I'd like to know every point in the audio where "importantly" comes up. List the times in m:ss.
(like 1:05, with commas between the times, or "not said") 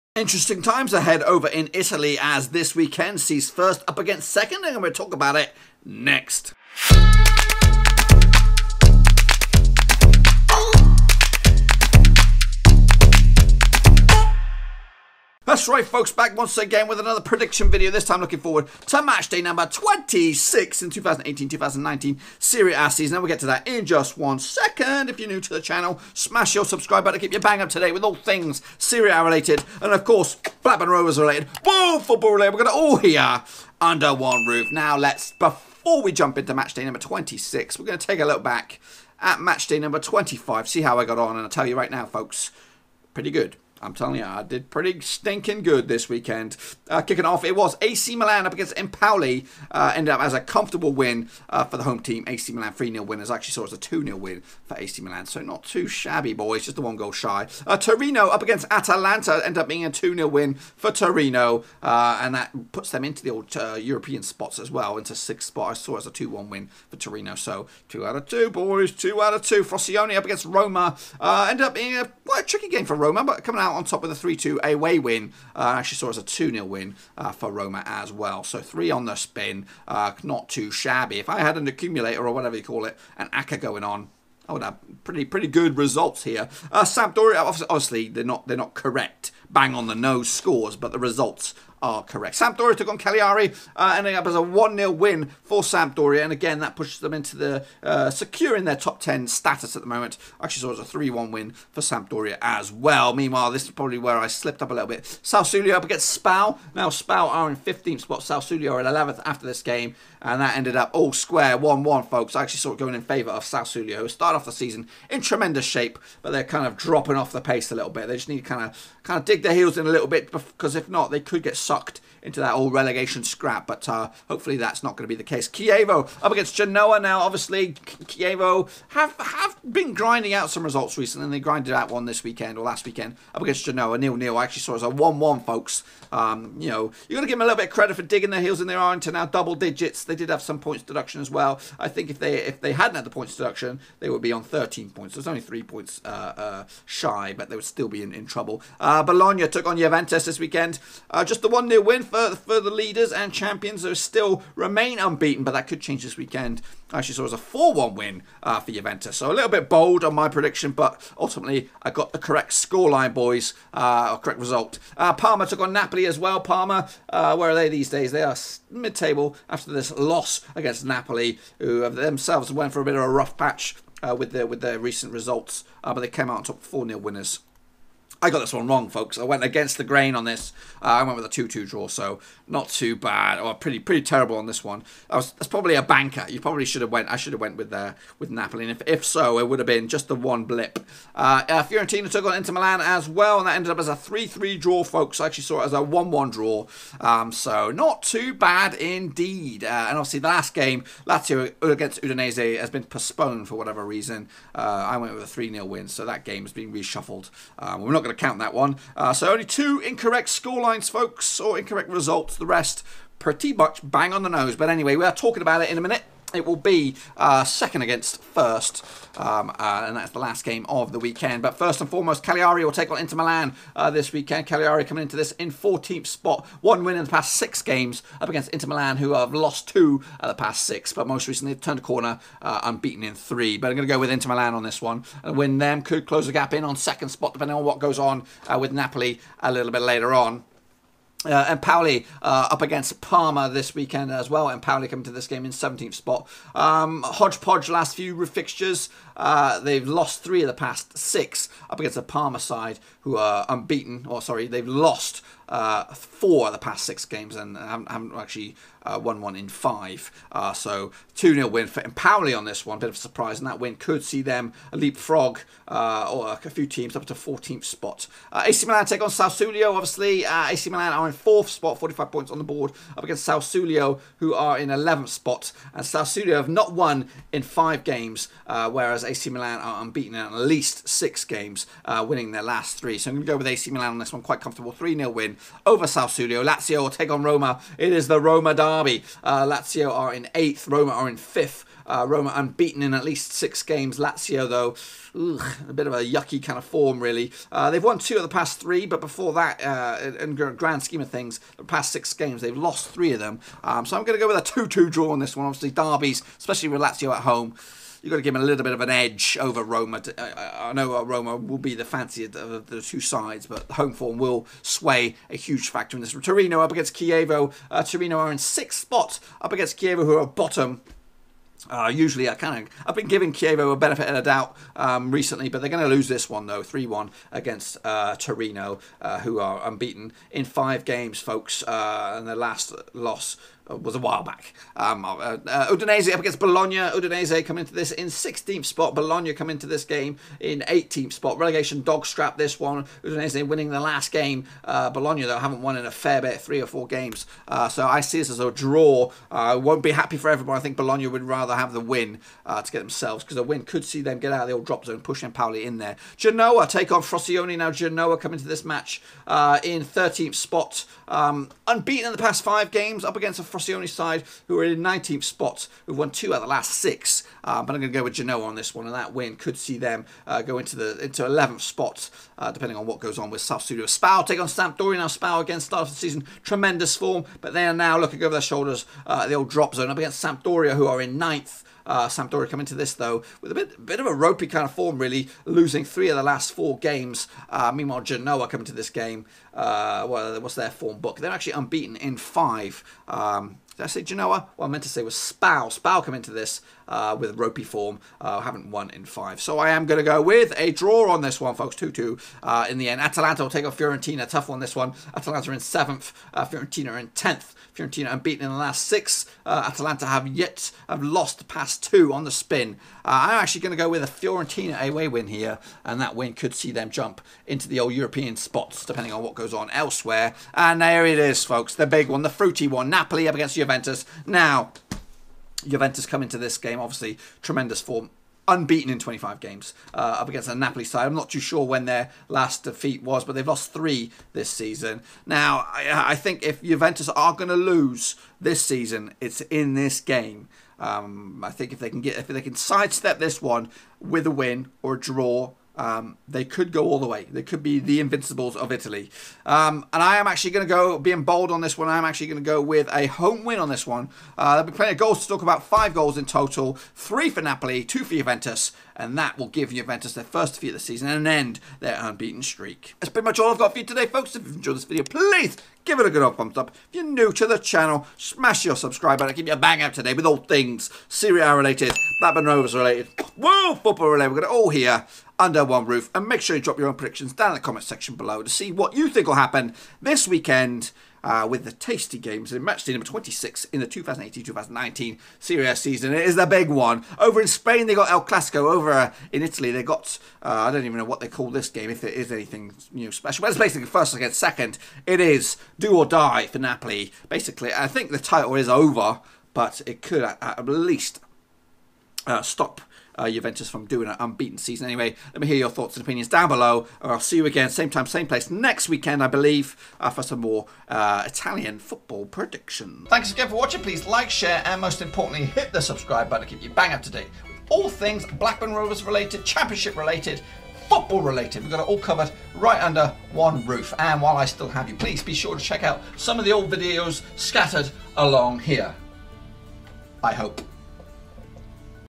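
8:35.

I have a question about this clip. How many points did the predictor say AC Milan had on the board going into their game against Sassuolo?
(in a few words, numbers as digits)
45.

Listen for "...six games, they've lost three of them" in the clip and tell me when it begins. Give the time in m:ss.
5:01.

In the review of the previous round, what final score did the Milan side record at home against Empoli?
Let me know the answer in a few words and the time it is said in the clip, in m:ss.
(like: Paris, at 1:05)
3-0, at 0:52.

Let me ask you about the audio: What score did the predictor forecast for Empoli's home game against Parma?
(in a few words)
2-0.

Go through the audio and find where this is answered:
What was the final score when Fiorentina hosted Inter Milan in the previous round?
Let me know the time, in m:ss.
3:13.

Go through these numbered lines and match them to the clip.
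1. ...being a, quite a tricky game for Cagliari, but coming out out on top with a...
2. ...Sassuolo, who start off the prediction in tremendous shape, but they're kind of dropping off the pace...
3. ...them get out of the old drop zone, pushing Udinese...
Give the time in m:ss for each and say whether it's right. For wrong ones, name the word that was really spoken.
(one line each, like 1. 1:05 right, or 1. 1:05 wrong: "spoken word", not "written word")
1. 1:11 wrong: "Roma", not "Cagliari"
2. 1:53 wrong: "season", not "prediction"
3. 5:54 wrong: "Empoli", not "Udinese".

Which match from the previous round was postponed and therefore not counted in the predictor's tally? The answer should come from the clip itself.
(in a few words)
Lazio against Udinese.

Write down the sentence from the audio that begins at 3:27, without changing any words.
Um, we're not going going to count that one.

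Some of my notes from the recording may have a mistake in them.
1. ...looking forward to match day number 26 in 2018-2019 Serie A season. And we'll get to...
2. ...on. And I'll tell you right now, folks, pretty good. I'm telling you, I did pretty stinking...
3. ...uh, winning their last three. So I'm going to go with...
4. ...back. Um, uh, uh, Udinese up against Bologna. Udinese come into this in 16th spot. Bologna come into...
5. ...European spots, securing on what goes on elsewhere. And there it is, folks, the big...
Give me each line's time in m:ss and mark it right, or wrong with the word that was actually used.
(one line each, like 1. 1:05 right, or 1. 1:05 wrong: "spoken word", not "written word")
1. 0:18 right
2. 0:41 right
3. 4:41 right
4. 5:34 right
5. 6:57 wrong: "depending", not "securing".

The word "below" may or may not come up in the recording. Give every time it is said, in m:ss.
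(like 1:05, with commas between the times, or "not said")
7:58, 8:26.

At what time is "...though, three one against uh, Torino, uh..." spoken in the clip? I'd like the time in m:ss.
5:26.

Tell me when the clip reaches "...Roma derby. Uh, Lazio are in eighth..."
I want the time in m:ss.
4:48.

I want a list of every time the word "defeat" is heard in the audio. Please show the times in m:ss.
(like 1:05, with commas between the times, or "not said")
7:12, 7:40.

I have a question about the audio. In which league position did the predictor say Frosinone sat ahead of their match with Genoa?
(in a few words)
19th.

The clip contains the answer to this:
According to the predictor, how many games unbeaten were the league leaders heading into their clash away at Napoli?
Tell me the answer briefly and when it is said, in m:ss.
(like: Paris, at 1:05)
25, at 7:08.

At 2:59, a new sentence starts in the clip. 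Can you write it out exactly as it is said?
I went against the grain on this.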